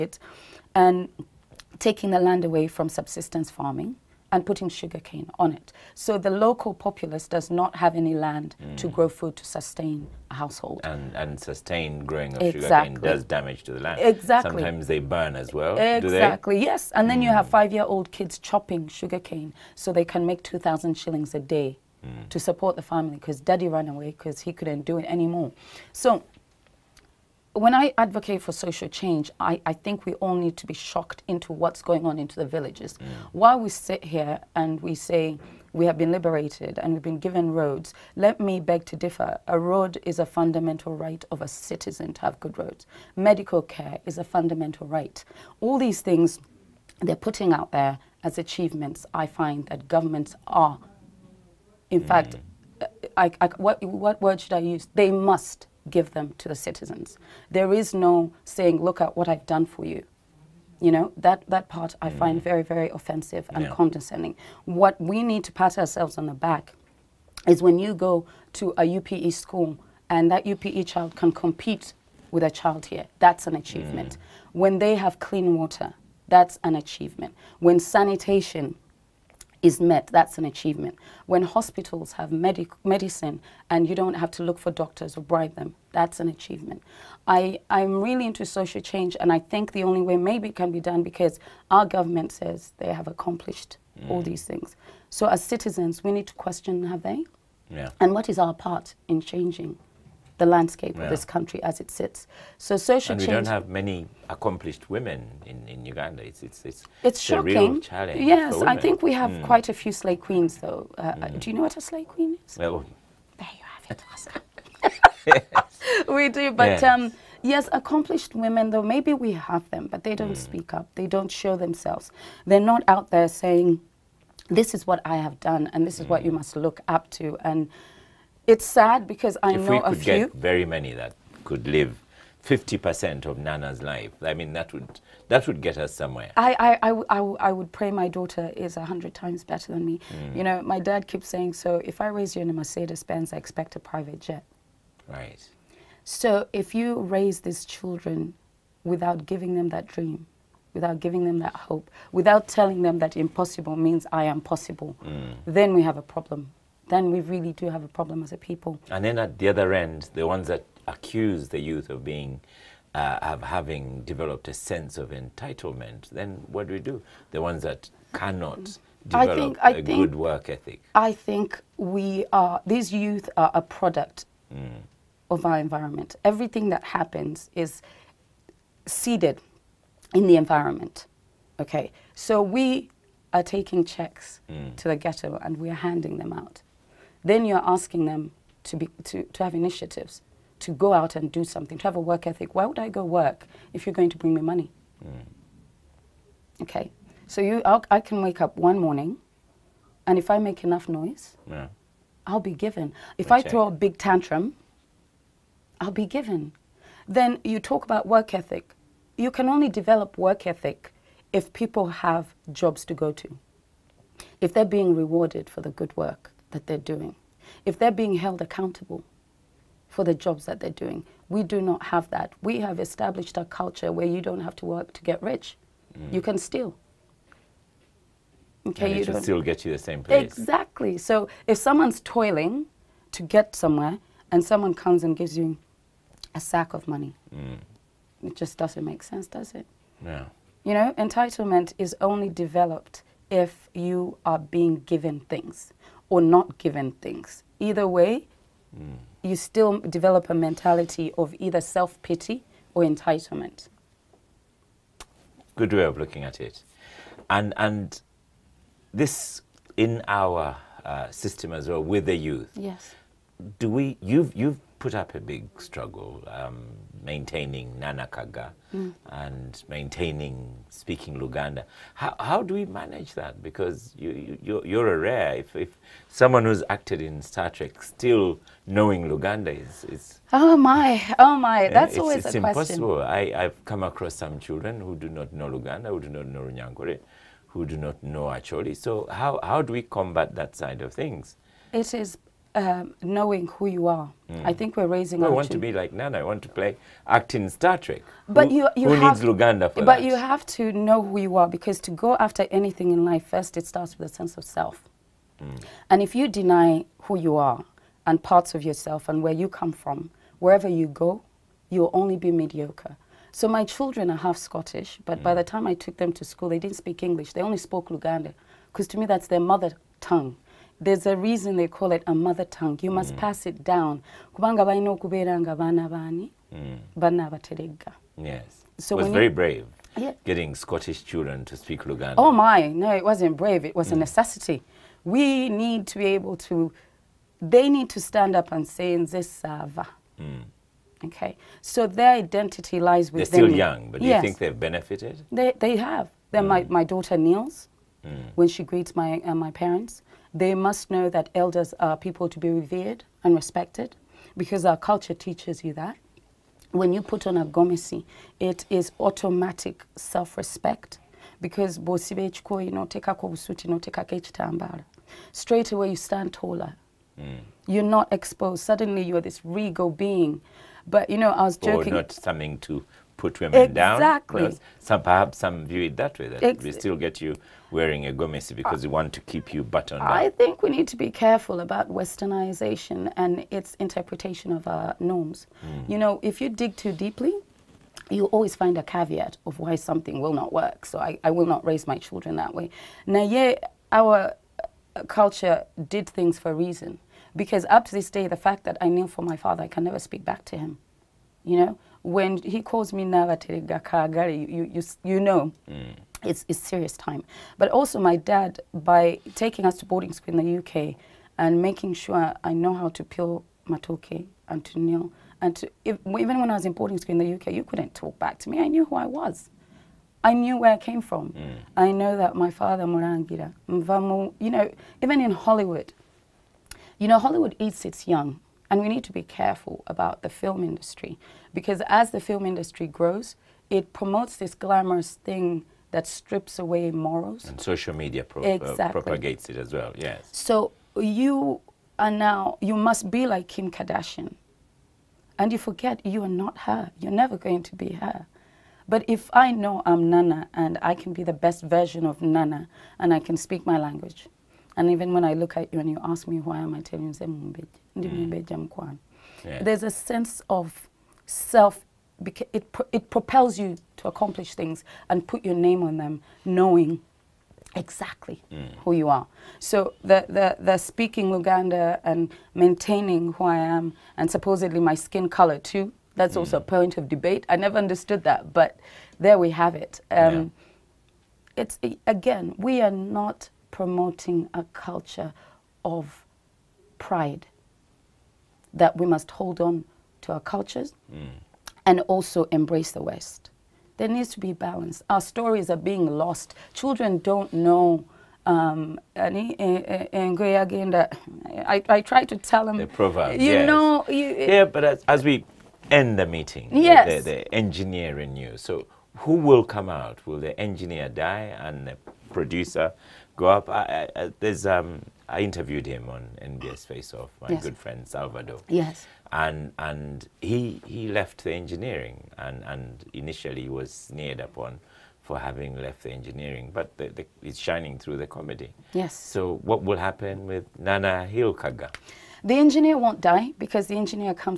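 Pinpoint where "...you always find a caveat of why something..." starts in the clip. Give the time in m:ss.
6:28.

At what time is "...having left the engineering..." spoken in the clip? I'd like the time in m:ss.
8:45.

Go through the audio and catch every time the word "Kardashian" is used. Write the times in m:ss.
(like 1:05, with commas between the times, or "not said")
7:23.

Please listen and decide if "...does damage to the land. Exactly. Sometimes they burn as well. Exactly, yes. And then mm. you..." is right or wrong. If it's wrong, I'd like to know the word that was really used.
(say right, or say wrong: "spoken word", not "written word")
right.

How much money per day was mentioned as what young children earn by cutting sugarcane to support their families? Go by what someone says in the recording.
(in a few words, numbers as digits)
2,000 shillings.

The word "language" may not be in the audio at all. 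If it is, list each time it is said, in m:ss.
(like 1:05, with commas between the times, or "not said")
7:33.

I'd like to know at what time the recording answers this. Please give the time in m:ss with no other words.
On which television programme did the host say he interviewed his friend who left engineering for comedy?
8:36.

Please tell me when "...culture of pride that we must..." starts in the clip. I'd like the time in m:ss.
8:04.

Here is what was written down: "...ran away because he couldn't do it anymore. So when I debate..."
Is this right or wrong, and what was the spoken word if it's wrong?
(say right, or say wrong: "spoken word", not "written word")
wrong: "advocate", not "debate".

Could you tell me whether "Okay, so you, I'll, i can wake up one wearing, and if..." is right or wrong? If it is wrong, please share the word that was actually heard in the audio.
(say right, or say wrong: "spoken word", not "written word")
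wrong: "morning", not "wearing".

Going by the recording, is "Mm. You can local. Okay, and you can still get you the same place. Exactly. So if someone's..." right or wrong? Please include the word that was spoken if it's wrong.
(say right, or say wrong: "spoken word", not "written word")
wrong: "steal", not "local".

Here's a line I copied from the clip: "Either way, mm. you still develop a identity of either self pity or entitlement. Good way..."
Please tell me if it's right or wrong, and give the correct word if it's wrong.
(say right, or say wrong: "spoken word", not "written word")
wrong: "mentality", not "identity".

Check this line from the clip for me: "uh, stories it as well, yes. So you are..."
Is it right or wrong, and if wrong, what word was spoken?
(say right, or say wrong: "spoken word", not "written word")
wrong: "propagates", not "stories".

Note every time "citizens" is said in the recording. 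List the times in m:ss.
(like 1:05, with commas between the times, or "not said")
0:41, 0:56, 1:35.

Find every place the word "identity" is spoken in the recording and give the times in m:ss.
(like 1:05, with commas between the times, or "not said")
5:42.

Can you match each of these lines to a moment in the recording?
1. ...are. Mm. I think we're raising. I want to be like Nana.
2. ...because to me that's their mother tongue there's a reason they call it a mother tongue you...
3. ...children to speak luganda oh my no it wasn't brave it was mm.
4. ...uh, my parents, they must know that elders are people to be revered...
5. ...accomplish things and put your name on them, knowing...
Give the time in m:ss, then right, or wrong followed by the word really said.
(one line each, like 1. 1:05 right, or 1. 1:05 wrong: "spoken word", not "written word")
1. 4:53 right
2. 5:18 right
3. 5:31 right
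4. 5:49 right
5. 7:44 right.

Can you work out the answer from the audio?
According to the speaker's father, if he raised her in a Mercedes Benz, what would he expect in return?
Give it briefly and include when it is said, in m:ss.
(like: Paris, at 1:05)
A private jet, at 2:23.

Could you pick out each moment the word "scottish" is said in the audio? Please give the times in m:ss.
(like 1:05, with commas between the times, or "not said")
5:14, 5:30.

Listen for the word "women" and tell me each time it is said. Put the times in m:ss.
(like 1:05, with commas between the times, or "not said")
1:44, 1:58, 6:13.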